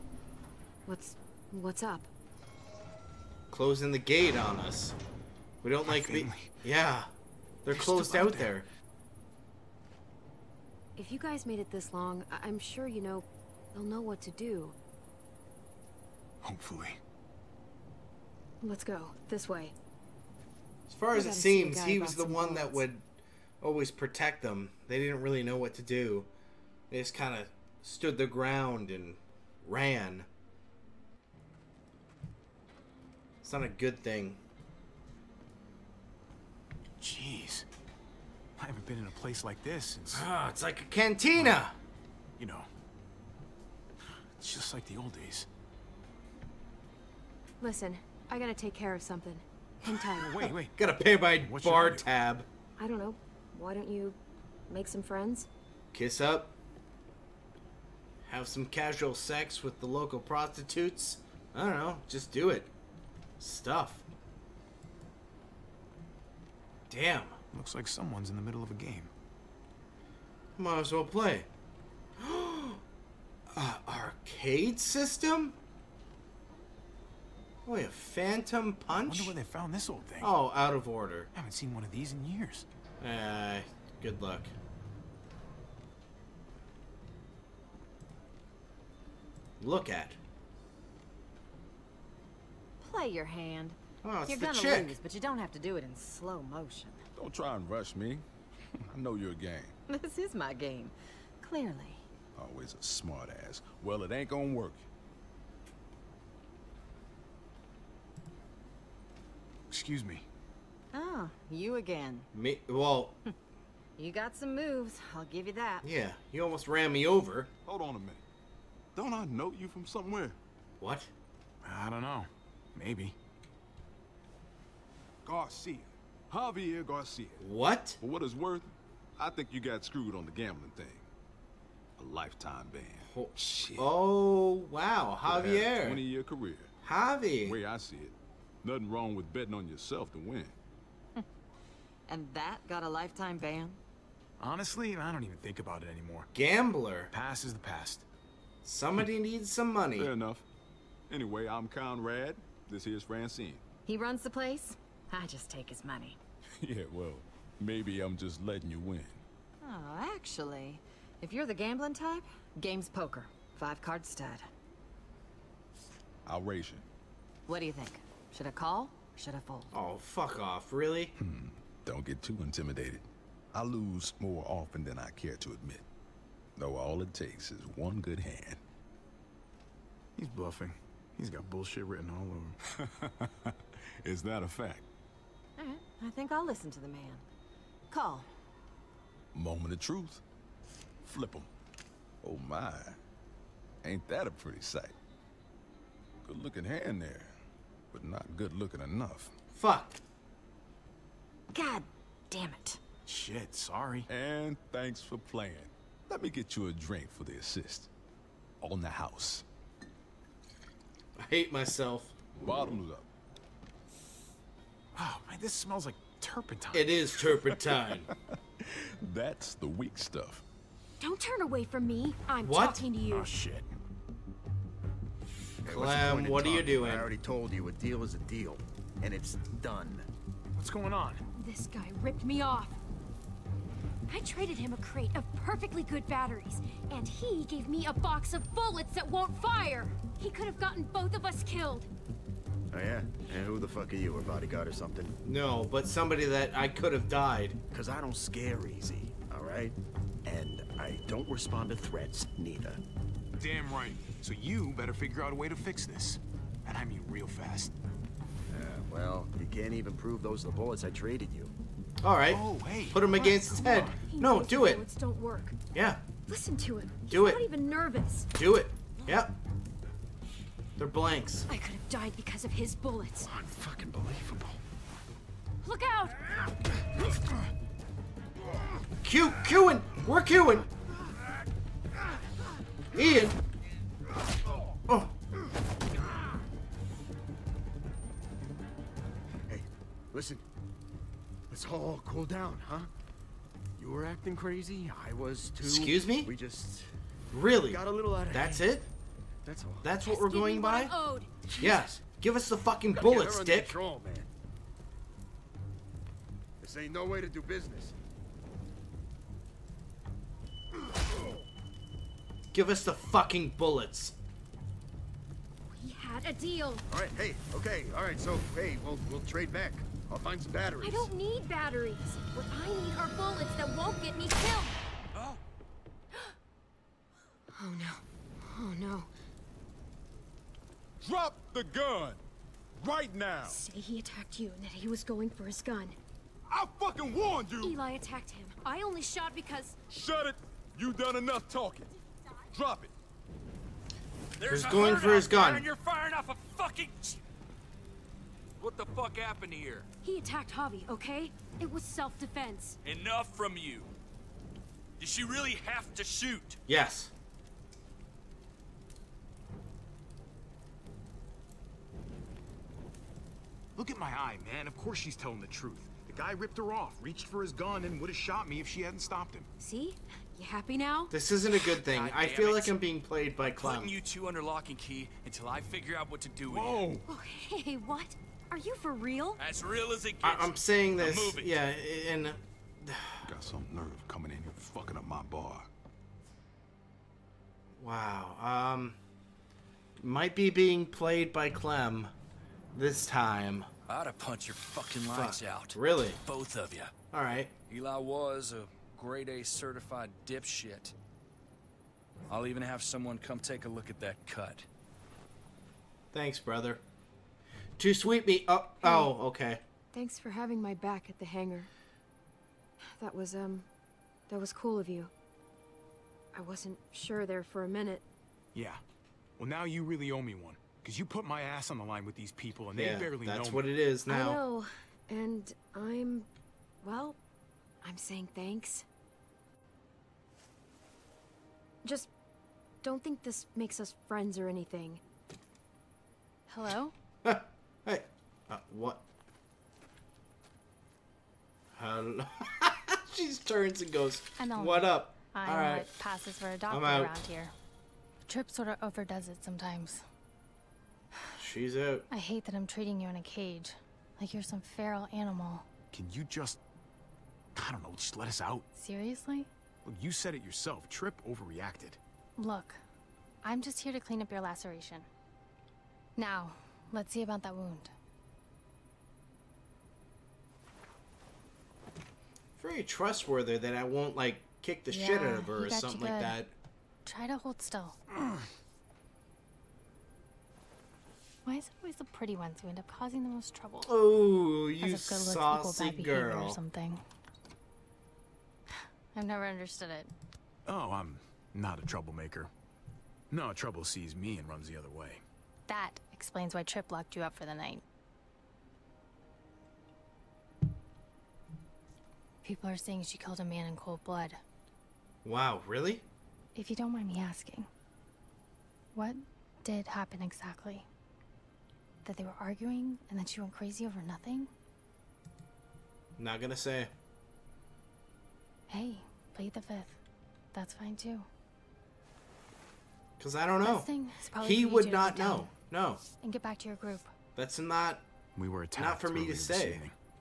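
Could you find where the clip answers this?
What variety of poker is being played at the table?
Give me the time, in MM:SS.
02:43.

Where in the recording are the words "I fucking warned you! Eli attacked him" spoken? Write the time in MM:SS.
05:36.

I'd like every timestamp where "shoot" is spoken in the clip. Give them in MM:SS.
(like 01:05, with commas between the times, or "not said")
05:56.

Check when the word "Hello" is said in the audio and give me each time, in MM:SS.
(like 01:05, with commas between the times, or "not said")
07:16, 07:21.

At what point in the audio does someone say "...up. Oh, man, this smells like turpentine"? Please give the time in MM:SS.
03:32.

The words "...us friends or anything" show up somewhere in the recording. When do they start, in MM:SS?
07:13.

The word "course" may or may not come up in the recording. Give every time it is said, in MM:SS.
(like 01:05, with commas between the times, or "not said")
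06:04.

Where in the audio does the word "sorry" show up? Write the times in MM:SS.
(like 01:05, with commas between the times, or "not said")
03:23.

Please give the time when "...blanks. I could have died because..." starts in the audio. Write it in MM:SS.
04:30.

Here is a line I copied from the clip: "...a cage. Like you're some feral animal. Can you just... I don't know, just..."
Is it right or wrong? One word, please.
right.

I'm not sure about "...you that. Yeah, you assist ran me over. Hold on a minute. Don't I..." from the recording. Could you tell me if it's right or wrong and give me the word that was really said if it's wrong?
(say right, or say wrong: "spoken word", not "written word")
wrong: "almost", not "assist".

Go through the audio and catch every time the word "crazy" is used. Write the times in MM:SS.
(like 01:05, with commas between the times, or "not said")
04:54, 08:33.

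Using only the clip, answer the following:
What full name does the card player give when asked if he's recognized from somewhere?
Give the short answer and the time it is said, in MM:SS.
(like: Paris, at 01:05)
Javier Garcia, at 02:05.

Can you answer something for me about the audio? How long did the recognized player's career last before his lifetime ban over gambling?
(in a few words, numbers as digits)
20 years.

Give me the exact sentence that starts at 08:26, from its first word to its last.
If you don't mind me asking, what did happen exactly?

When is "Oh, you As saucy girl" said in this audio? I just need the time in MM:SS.
08:03.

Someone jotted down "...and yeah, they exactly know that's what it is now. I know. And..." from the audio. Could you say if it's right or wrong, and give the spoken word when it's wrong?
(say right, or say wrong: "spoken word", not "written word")
wrong: "barely", not "exactly".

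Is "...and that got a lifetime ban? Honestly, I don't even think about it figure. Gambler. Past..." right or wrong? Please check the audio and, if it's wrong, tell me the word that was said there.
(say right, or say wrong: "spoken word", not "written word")
wrong: "anymore", not "figure".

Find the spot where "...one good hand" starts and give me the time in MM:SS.
02:57.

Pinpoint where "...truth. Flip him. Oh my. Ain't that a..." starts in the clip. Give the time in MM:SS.
03:09.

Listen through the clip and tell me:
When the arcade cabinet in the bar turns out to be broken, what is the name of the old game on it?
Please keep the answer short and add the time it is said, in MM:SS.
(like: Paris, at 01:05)
Phantom Punch, at 01:17.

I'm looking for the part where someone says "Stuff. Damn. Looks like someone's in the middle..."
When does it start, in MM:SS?
01:03.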